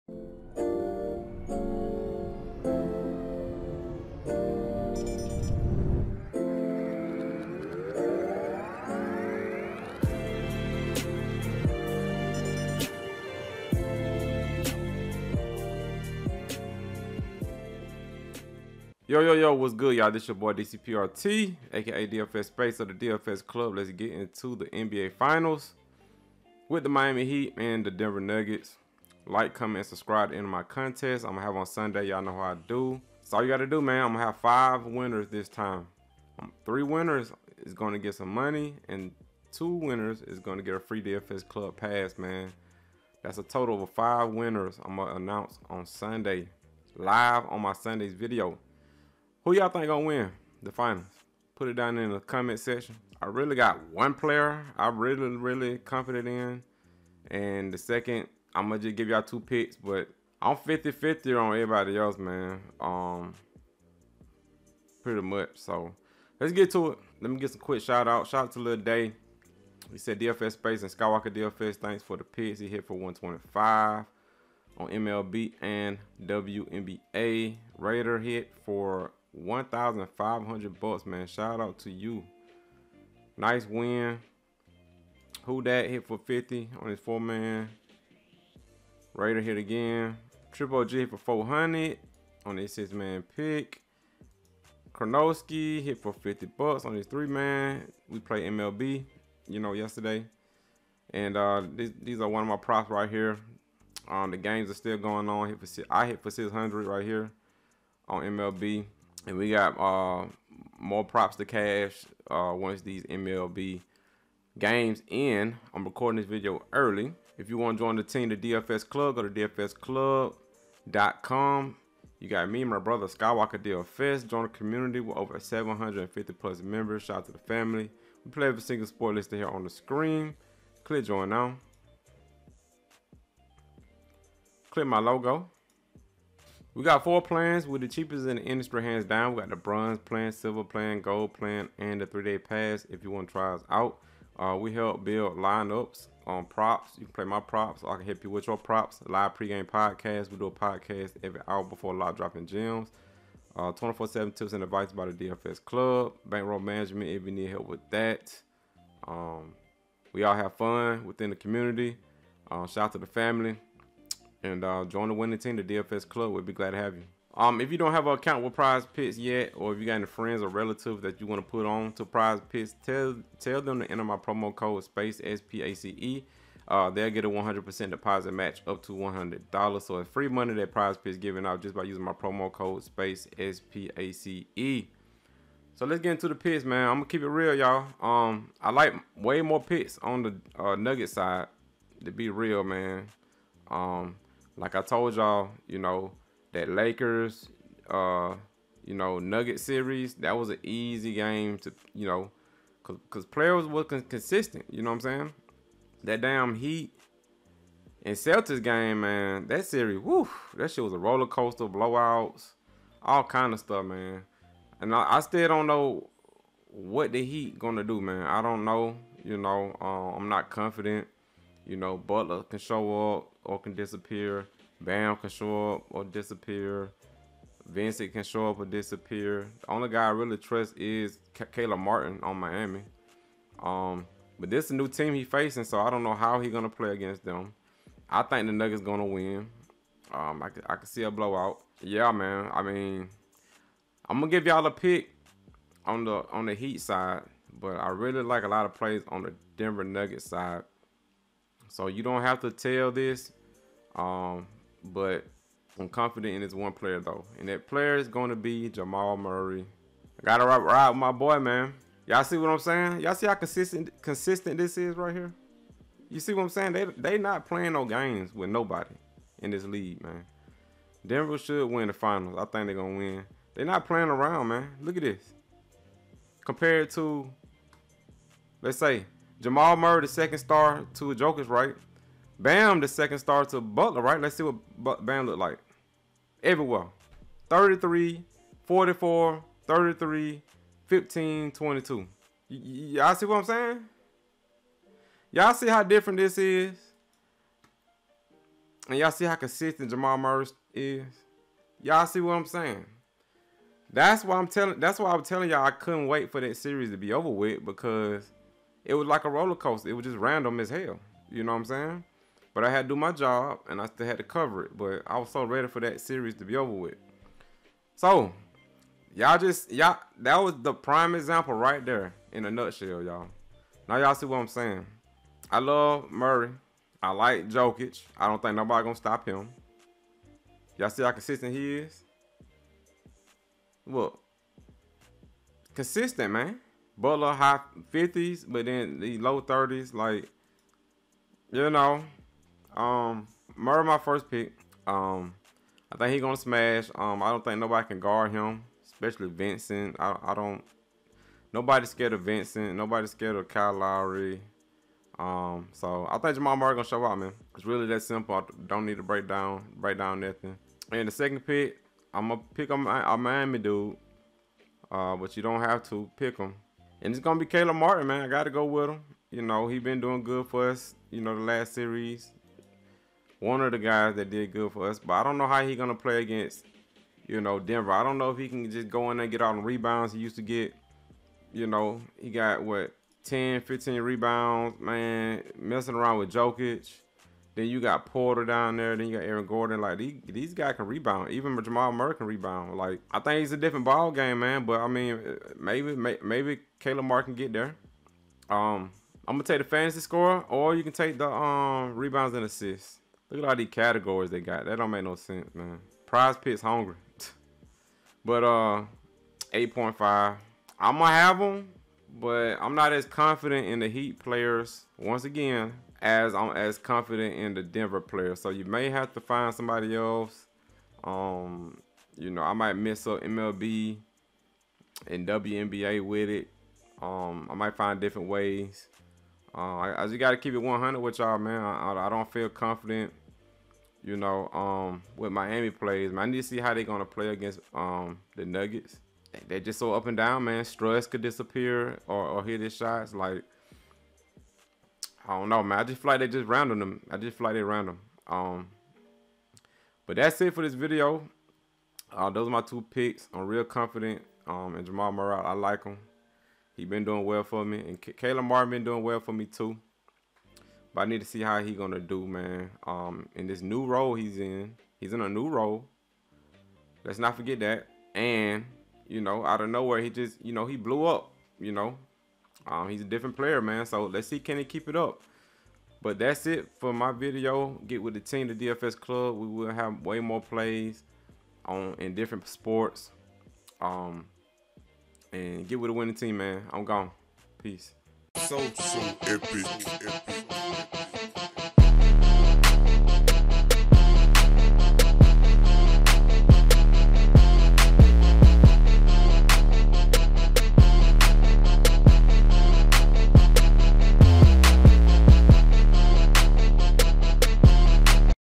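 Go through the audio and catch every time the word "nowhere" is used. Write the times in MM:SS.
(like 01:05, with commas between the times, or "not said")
07:49.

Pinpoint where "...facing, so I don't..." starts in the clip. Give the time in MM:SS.
03:55.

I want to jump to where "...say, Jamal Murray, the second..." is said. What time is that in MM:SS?
04:38.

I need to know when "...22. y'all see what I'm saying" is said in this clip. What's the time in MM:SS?
04:51.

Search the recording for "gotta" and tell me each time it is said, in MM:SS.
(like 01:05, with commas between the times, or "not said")
00:33, 04:20, 06:08.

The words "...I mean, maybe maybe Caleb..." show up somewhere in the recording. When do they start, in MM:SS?
06:34.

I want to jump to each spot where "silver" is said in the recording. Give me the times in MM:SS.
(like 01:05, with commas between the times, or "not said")
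02:20.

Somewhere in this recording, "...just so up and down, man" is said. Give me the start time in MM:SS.
07:19.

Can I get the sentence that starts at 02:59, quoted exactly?
So it's free money that Prize Picks giving out just by using my promo code Space S P A C E.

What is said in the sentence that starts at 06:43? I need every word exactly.
Look at all these categories they got.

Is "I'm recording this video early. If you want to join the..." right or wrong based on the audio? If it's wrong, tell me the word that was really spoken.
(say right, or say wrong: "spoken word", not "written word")
right.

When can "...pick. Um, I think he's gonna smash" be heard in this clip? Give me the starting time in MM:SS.
05:44.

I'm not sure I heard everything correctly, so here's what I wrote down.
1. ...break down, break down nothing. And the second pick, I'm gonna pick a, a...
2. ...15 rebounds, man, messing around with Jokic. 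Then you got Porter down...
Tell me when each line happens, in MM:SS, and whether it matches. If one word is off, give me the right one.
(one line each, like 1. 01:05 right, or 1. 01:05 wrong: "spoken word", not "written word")
1. 05:59 right
2. 06:23 right.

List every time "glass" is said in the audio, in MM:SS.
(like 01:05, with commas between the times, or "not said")
not said.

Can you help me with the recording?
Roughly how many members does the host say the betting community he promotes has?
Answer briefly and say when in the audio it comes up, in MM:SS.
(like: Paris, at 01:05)
750, at 02:05.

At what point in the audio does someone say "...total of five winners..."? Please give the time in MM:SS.
00:43.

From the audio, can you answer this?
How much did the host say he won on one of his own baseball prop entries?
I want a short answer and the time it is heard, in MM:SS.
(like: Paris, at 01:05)
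$600, at 01:46.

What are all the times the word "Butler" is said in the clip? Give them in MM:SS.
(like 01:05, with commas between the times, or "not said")
03:41, 04:43, 05:37.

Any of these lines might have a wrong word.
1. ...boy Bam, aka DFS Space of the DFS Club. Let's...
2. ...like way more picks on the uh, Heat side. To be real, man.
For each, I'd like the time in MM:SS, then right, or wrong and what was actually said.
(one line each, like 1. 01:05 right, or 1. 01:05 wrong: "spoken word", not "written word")
1. 00:20 wrong: "DCPRT", not "Bam"
2. 03:08 wrong: "Nugget", not "Heat".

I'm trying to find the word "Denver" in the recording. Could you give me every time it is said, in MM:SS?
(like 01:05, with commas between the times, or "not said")
00:27, 04:09, 04:31, 06:17, 06:57.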